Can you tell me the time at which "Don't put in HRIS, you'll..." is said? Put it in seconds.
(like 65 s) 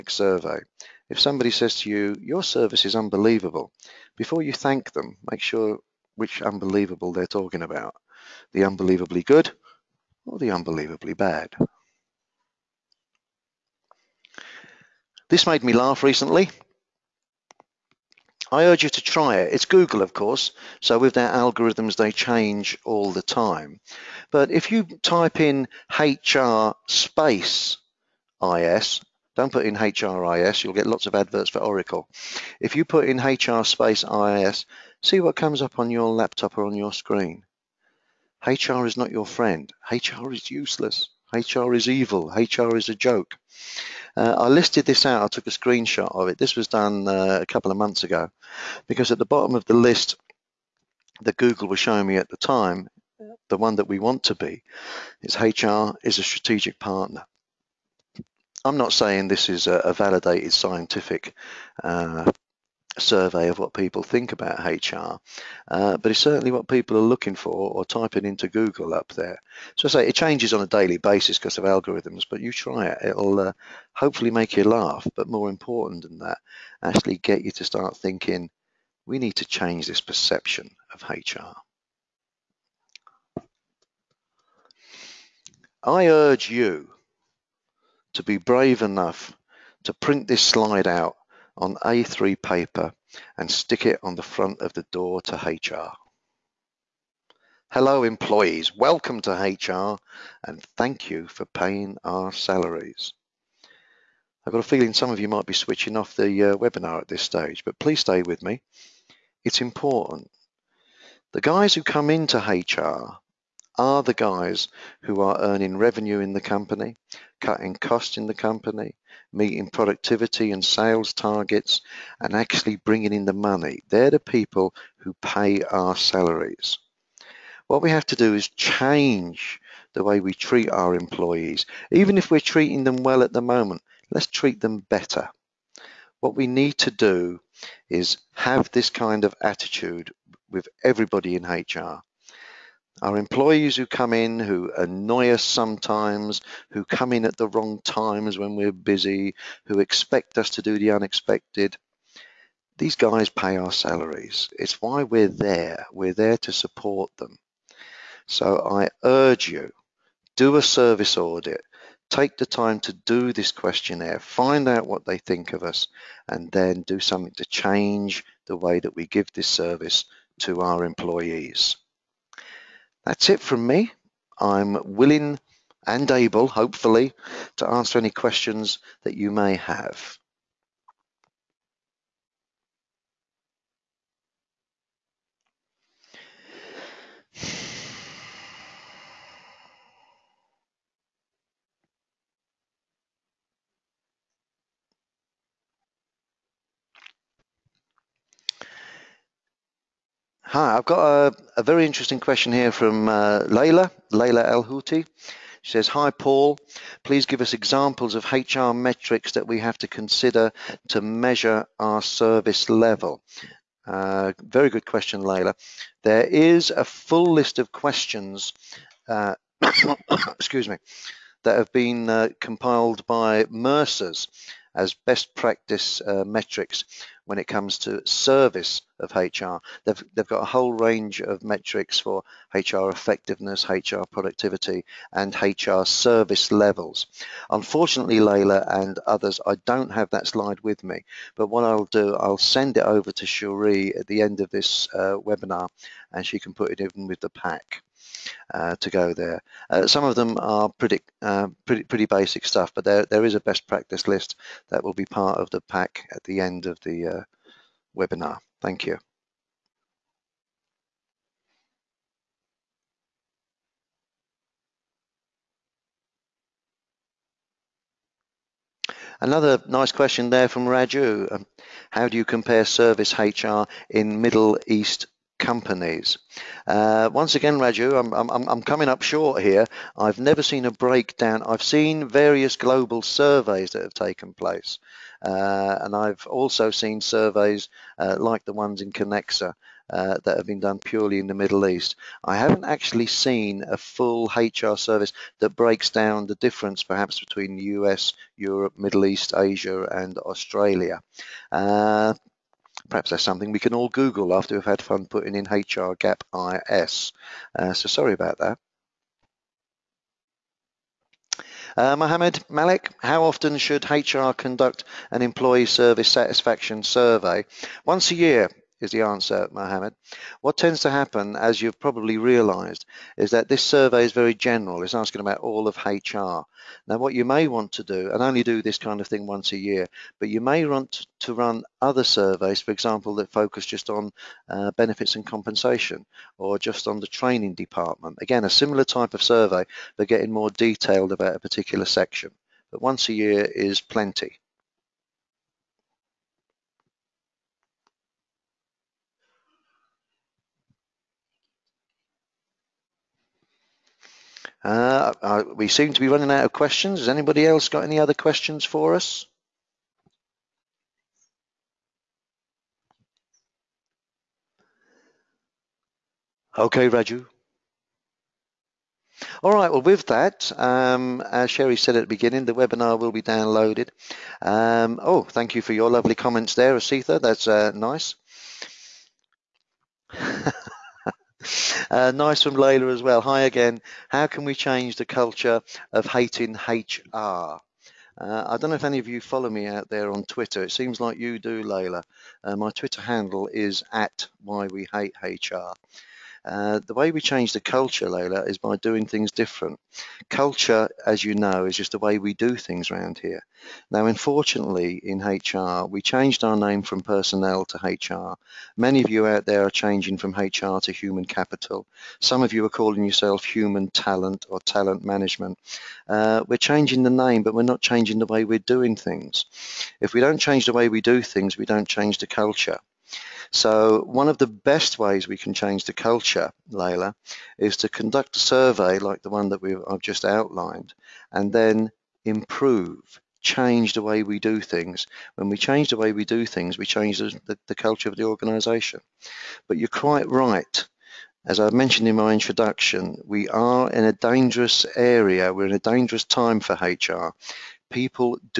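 29 s.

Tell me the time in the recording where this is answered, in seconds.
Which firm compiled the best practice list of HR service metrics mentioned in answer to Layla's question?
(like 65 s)
223 s.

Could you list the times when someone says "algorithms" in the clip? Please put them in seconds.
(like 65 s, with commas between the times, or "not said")
21 s, 71 s.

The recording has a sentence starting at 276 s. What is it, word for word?
Uh, once again, Raju, I'm, I'm, I'm, coming up short here.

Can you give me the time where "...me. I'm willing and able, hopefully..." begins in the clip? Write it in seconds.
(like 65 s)
173 s.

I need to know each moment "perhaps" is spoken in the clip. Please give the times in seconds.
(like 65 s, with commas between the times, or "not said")
296 s, 302 s.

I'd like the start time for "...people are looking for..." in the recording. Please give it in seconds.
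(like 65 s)
66 s.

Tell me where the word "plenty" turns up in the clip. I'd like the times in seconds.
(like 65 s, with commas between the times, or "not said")
343 s.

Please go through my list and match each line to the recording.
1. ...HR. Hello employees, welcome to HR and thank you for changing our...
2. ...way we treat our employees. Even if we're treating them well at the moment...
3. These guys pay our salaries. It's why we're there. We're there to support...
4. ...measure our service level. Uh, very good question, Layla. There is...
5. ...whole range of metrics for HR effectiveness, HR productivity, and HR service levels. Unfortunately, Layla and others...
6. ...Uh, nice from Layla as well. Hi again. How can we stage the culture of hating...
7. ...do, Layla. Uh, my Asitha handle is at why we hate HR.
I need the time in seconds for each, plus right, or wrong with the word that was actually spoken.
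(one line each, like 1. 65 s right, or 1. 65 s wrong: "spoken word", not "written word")
1. 95 s wrong: "paying", not "changing"
2. 130 s right
3. 152 s right
4. 211 s right
5. 230 s right
6. 381 s wrong: "change", not "stage"
7. 391 s wrong: "Twitter", not "Asitha".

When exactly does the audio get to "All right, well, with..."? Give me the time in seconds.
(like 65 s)
369 s.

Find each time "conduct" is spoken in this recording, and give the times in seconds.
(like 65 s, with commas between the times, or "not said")
314 s, 427 s.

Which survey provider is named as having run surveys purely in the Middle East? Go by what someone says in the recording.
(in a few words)
Kenexa.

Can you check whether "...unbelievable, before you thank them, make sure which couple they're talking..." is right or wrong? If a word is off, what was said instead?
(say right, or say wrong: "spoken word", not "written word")
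wrong: "unbelievable", not "couple".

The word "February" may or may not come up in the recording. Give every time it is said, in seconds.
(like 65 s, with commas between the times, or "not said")
not said.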